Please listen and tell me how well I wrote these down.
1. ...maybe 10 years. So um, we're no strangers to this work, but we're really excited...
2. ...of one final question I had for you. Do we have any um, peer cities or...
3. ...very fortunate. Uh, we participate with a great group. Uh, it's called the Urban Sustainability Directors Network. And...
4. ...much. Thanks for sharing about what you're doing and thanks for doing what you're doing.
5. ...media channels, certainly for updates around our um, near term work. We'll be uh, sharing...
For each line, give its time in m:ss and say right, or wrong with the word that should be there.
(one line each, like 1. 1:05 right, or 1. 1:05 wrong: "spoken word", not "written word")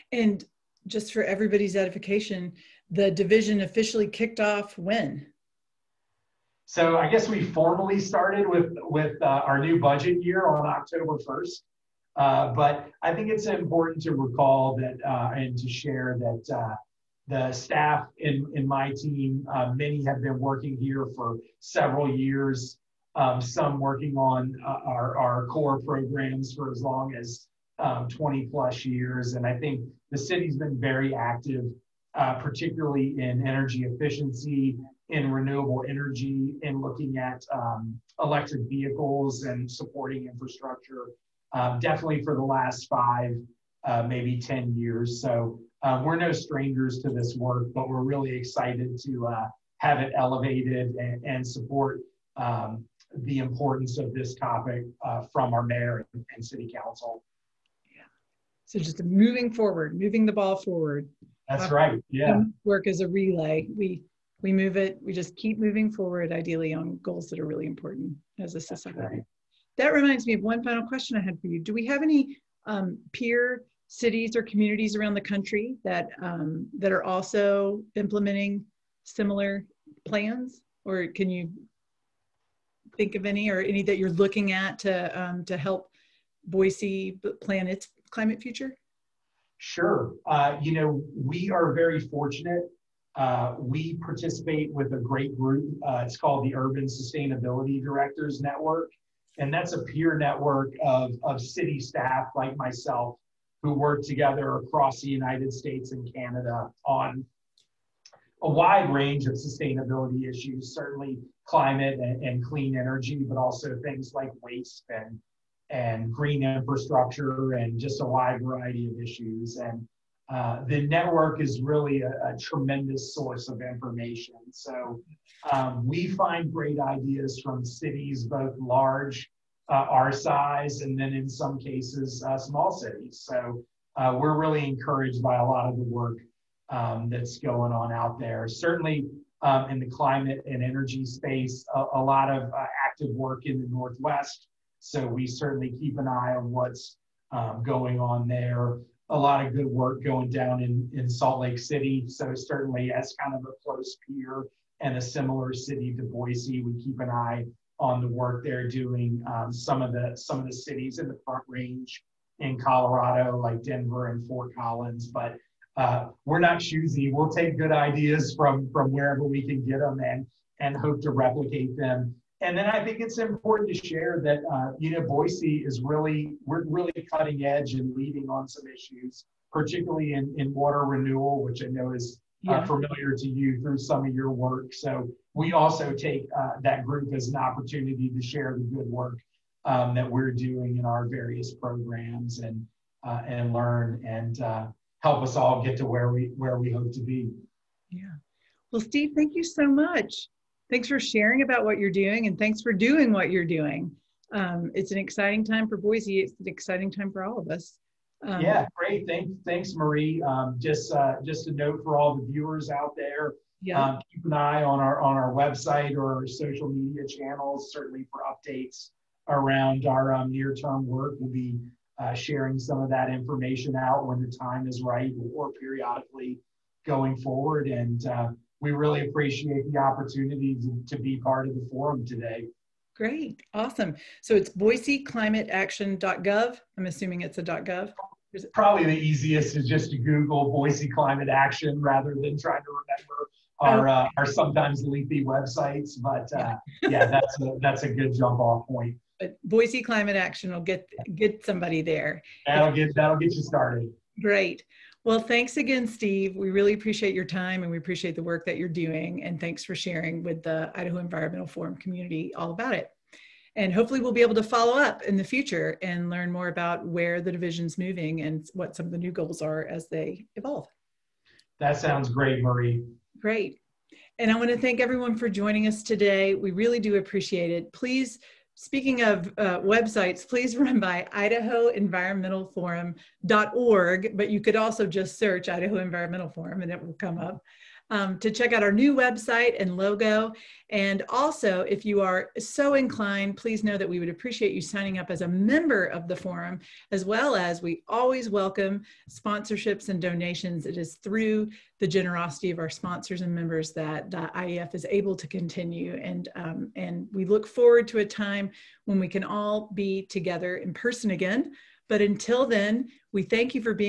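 1. 0:44 right
2. 1:10 right
3. 1:31 right
4. 3:19 right
5. 3:36 right.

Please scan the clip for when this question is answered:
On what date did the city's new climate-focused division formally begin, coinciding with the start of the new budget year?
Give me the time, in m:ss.
0:10.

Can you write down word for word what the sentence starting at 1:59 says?
And uh, the network is really a, a, tremendous source of information.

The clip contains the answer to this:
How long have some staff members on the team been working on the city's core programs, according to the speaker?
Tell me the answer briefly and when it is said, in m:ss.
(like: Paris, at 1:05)
20 plus years, at 0:28.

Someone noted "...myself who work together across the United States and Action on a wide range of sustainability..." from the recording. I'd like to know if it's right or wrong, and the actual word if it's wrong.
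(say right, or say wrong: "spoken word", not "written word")
wrong: "Canada", not "Action".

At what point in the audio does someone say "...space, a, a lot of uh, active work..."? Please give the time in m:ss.
2:21.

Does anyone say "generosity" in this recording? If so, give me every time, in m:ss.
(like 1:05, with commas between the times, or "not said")
5:01.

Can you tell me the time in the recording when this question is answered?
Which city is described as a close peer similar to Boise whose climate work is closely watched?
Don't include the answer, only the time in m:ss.
2:31.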